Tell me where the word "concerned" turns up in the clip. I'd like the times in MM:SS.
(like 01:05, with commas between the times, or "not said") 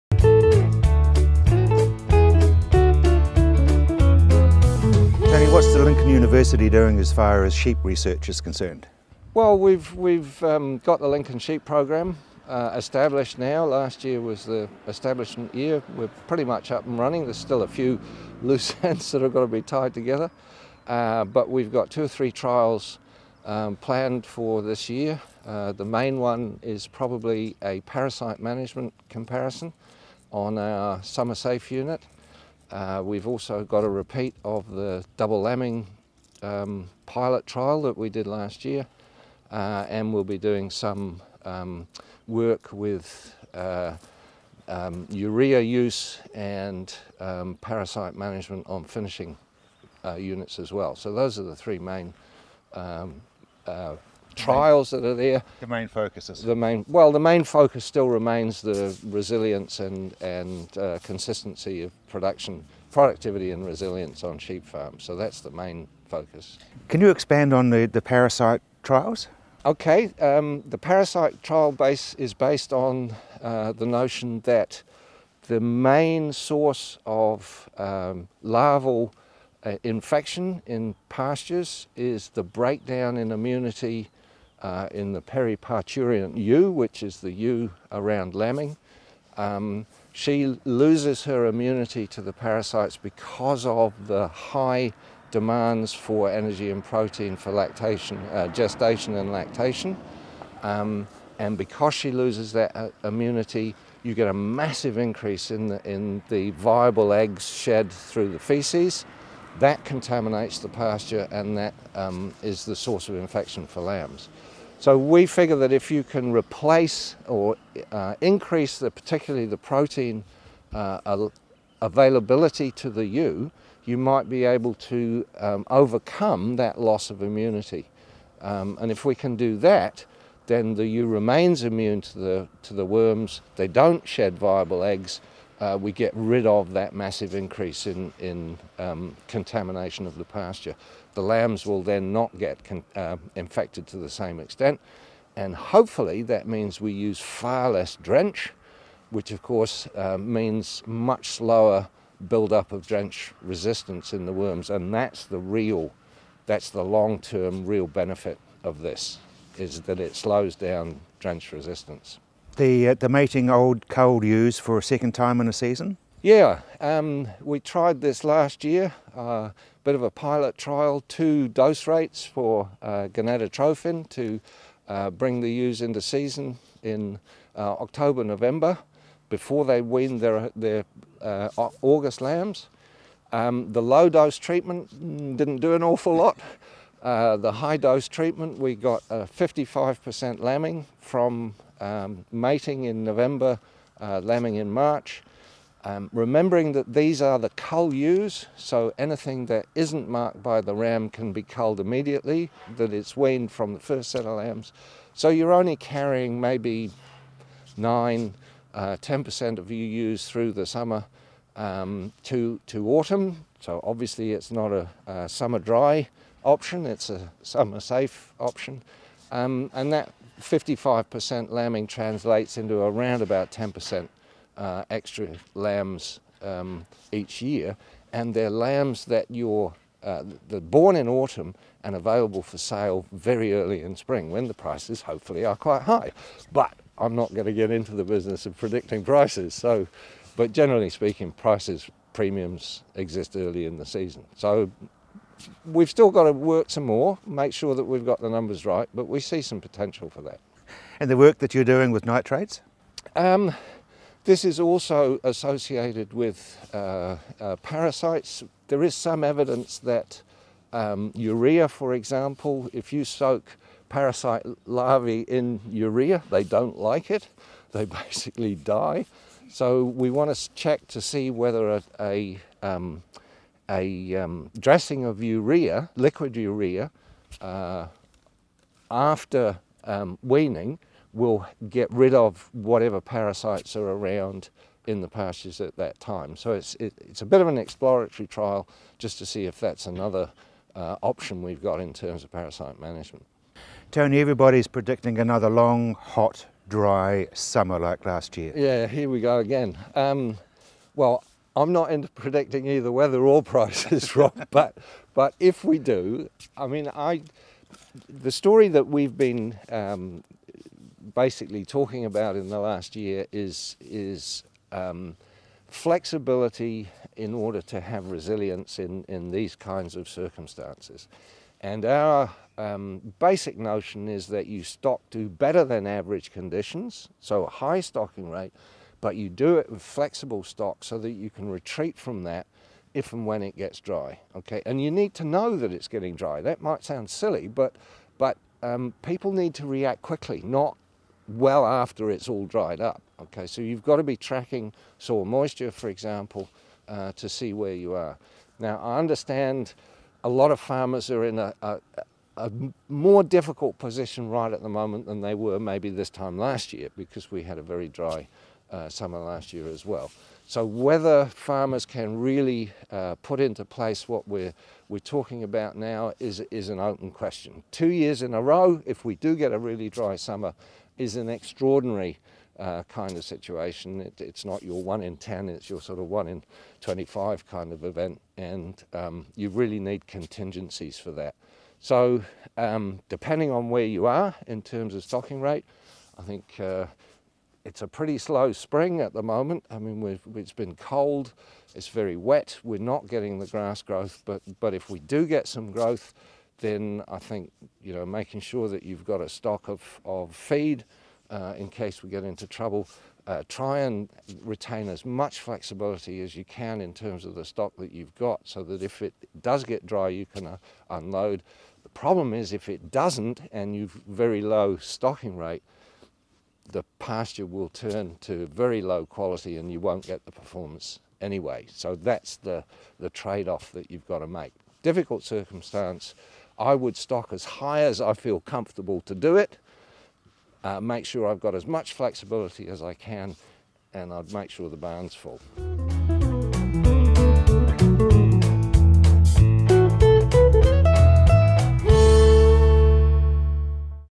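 00:08.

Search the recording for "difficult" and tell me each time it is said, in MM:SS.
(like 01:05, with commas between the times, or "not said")
05:53, 07:04.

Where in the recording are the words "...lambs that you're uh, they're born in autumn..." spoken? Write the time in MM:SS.
03:48.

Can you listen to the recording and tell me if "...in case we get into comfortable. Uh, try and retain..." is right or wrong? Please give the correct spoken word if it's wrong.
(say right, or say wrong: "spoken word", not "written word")
wrong: "trouble", not "comfortable".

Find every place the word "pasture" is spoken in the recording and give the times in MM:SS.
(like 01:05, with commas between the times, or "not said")
01:21, 01:50, 02:20, 04:45, 06:56.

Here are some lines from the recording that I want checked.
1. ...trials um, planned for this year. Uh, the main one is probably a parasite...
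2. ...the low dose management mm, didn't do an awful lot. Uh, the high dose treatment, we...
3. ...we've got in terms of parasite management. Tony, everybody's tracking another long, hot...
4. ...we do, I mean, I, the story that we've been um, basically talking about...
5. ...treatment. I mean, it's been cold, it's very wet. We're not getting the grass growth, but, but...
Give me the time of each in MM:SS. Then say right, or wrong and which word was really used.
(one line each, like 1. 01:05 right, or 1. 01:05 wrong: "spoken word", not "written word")
1. 00:22 right
2. 03:03 wrong: "treatment", not "management"
3. 04:51 wrong: "predicting", not "tracking"
4. 05:05 right
5. 06:29 wrong: "moment", not "treatment".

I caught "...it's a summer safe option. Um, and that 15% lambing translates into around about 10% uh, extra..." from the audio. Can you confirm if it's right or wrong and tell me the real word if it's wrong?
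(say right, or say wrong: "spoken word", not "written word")
wrong: "55", not "15".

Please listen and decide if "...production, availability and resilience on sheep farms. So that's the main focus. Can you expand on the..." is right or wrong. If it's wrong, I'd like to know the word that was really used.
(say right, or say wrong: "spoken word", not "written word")
wrong: "productivity", not "availability".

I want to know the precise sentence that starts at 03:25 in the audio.
So you're only carrying maybe nine, 10% uh, of you use through the summer um, to, to autumn.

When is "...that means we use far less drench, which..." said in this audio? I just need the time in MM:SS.
02:26.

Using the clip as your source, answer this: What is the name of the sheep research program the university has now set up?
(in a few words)
Lincoln Sheep Program.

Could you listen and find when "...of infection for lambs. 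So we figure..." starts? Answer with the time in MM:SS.
01:53.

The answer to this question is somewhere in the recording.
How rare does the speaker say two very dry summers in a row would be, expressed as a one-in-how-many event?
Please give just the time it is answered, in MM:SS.
06:16.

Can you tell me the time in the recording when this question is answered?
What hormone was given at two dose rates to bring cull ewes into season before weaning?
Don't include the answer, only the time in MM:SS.
02:53.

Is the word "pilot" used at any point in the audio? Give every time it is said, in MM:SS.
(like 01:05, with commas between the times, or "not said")
00:37, 02:50.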